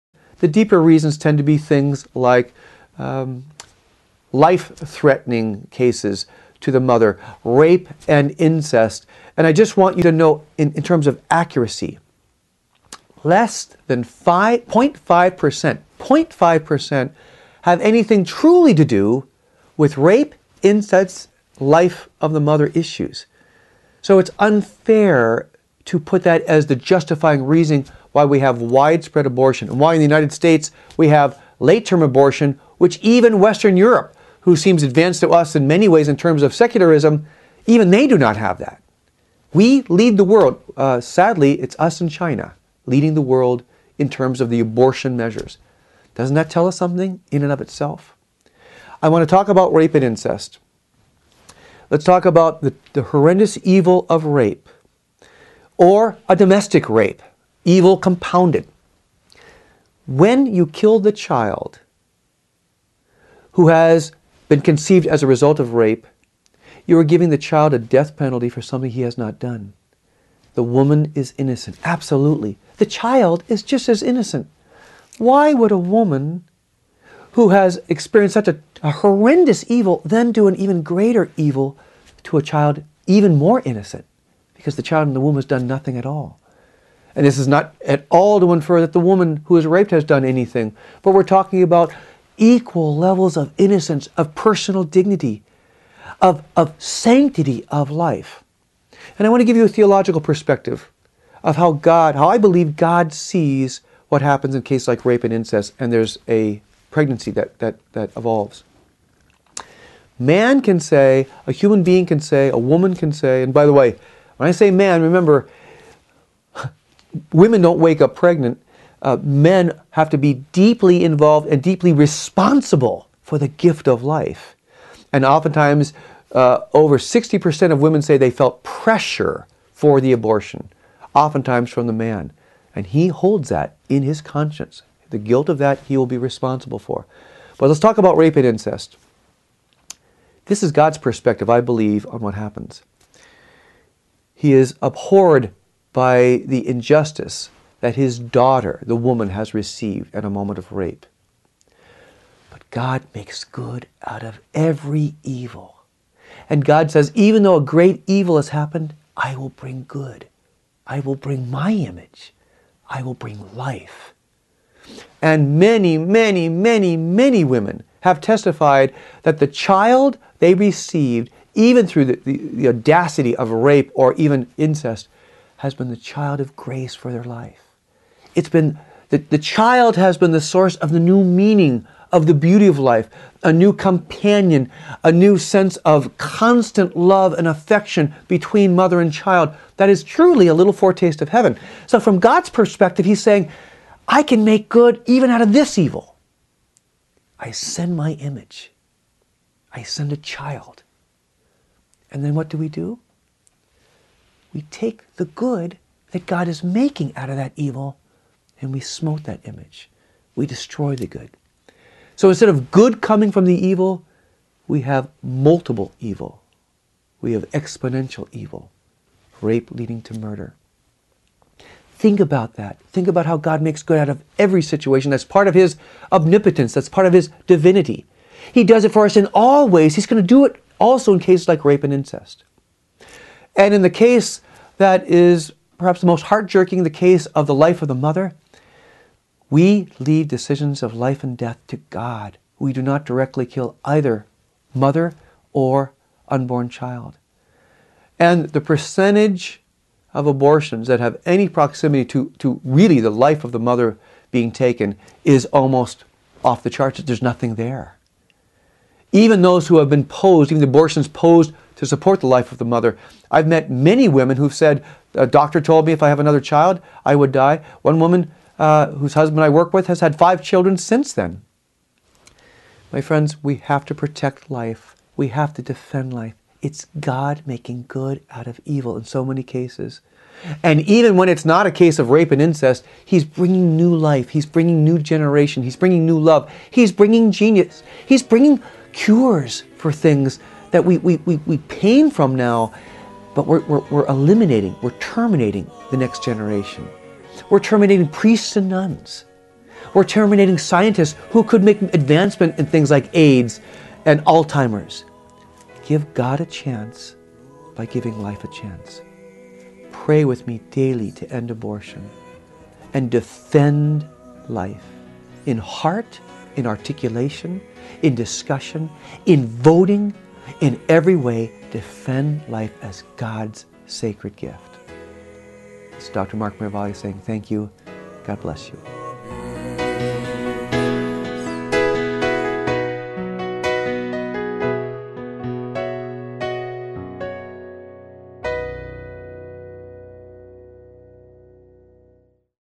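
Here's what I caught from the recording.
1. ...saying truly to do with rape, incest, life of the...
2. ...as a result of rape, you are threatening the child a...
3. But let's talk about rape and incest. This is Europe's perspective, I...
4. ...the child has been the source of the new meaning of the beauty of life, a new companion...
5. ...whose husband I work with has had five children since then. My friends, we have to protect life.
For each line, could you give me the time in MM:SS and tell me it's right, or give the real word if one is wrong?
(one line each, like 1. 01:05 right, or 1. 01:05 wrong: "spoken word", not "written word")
1. 00:17 wrong: "anything", not "saying"
2. 01:05 wrong: "giving", not "threatening"
3. 02:17 wrong: "God", not "Europe"
4. 02:59 right
5. 04:28 right.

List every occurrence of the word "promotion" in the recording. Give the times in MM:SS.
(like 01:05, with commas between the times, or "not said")
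not said.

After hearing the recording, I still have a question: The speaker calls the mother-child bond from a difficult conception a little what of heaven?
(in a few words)
foretaste.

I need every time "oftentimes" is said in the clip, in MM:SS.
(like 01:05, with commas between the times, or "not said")
02:05, 02:11.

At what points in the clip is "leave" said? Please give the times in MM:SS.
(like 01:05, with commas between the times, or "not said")
03:59.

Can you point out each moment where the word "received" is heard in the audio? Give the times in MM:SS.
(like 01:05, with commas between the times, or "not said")
02:29, 02:50.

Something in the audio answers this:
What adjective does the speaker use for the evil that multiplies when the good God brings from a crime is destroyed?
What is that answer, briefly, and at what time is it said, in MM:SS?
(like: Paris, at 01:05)
exponential, at 03:37.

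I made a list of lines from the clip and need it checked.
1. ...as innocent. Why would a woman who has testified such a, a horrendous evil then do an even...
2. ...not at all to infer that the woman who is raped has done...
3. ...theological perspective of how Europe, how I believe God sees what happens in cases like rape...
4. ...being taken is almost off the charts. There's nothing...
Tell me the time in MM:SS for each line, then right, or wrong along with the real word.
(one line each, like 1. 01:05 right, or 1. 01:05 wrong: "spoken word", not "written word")
1. 01:13 wrong: "experienced", not "testified"
2. 01:27 right
3. 01:39 wrong: "God", not "Europe"
4. 04:14 right.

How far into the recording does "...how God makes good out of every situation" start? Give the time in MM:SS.
03:43.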